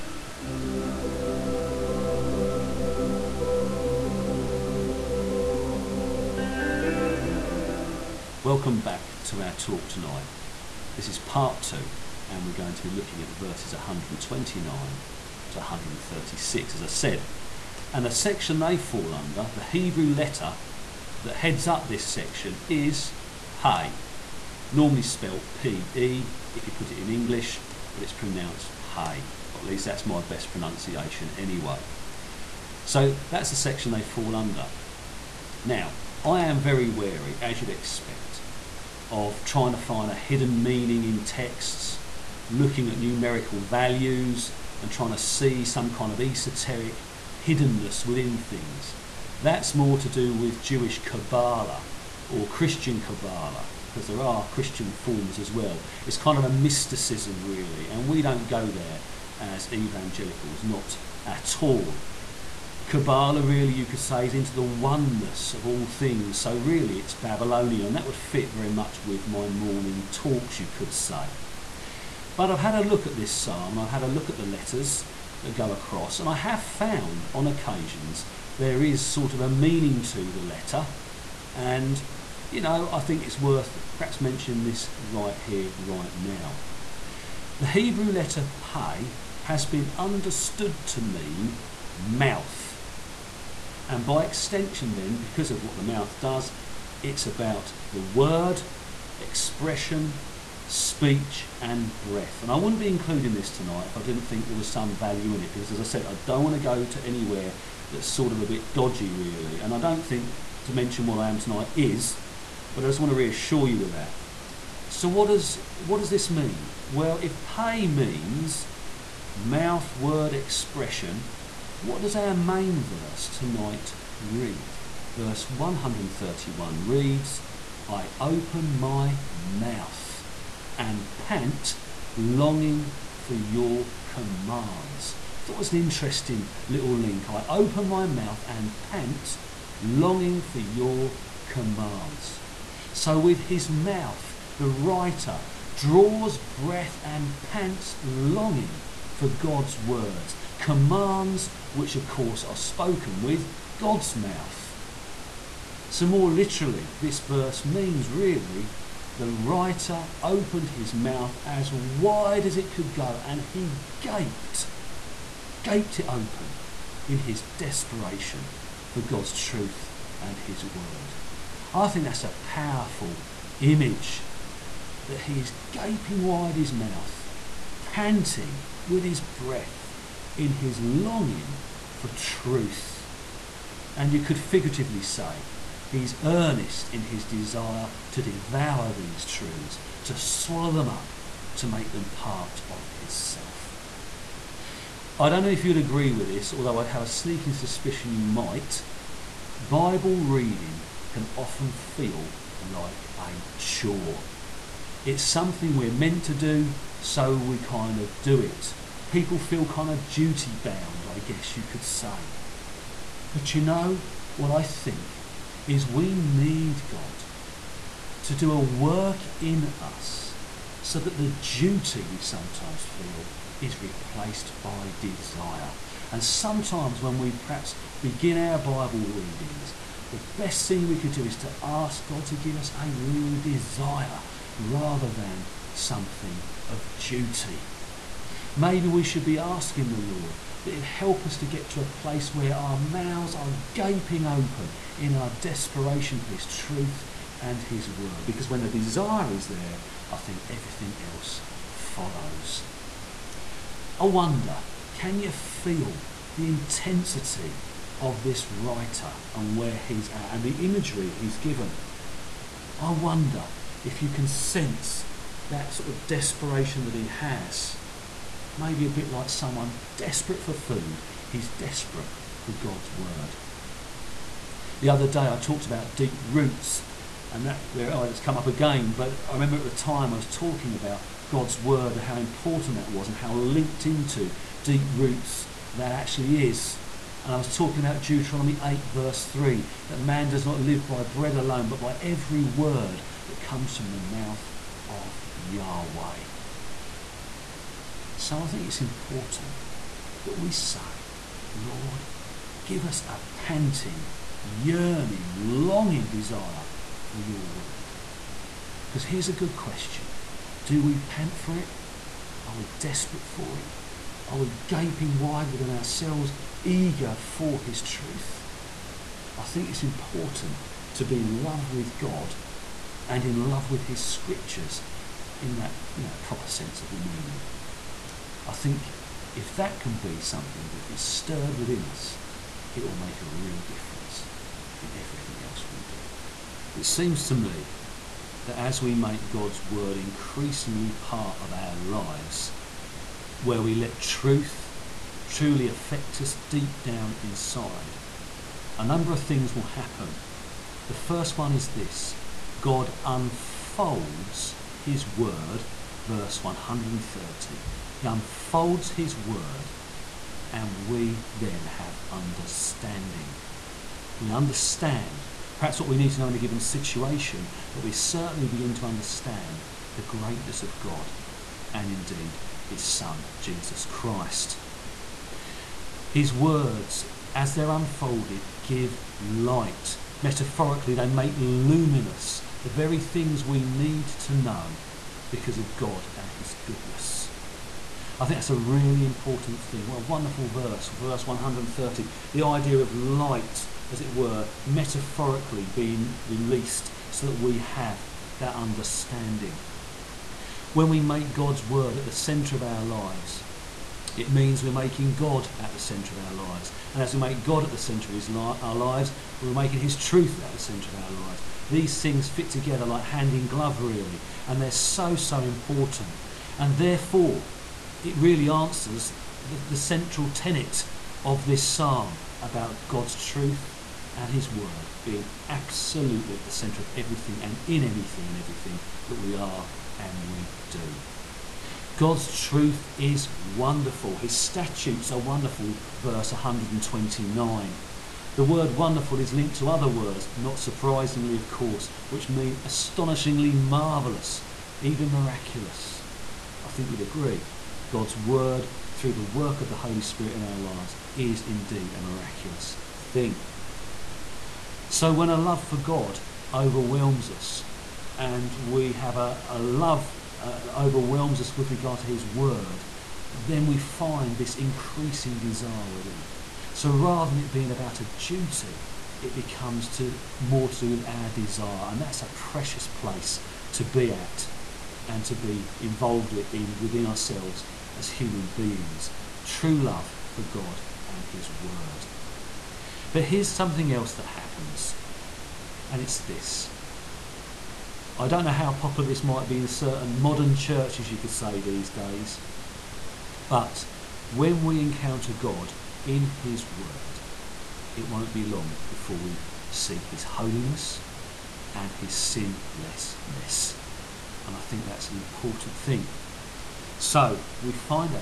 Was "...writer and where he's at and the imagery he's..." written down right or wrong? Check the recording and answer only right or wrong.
right.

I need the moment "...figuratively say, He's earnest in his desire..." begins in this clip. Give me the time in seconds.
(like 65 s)
184 s.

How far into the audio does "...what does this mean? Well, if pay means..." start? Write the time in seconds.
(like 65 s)
115 s.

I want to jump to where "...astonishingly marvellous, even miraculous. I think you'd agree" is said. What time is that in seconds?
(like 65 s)
442 s.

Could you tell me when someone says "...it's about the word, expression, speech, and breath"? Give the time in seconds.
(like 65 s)
97 s.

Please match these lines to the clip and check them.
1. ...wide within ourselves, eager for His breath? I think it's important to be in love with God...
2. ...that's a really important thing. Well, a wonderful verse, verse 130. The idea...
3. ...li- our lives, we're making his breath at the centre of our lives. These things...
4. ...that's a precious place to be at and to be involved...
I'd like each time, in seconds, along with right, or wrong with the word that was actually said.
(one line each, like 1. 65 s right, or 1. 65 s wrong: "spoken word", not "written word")
1. 315 s wrong: "truth", not "breath"
2. 388 s right
3. 408 s wrong: "truth", not "breath"
4. 472 s right.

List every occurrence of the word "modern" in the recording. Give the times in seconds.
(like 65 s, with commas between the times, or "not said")
490 s.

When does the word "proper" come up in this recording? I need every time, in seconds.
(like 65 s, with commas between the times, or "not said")
326 s.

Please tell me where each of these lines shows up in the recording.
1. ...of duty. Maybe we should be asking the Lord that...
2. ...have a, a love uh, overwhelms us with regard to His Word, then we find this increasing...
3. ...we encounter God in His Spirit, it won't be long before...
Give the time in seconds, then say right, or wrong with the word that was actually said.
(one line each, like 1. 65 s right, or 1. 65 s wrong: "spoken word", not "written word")
1. 236 s right
2. 458 s right
3. 494 s wrong: "Word", not "Spirit".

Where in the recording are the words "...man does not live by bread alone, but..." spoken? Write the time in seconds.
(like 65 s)
289 s.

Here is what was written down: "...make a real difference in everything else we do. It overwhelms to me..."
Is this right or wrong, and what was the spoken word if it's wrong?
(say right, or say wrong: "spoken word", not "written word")
wrong: "seems", not "overwhelms".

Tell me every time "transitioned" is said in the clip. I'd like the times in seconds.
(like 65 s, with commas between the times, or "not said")
not said.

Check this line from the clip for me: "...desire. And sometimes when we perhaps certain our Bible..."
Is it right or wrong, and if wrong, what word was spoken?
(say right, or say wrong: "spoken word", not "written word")
wrong: "begin", not "certain".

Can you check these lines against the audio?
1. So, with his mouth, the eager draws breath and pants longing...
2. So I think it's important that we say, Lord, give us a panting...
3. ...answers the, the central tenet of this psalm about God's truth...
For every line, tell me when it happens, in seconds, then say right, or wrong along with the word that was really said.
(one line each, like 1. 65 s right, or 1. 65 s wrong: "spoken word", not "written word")
1. 142 s wrong: "writer", not "eager"
2. 298 s right
3. 418 s right.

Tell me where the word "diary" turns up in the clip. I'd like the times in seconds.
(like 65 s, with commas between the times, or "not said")
not said.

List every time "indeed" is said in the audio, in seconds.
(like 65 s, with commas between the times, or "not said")
371 s, 451 s.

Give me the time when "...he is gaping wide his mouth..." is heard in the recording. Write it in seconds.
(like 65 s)
175 s.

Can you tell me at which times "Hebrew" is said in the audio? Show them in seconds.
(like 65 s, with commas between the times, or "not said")
19 s, 87 s.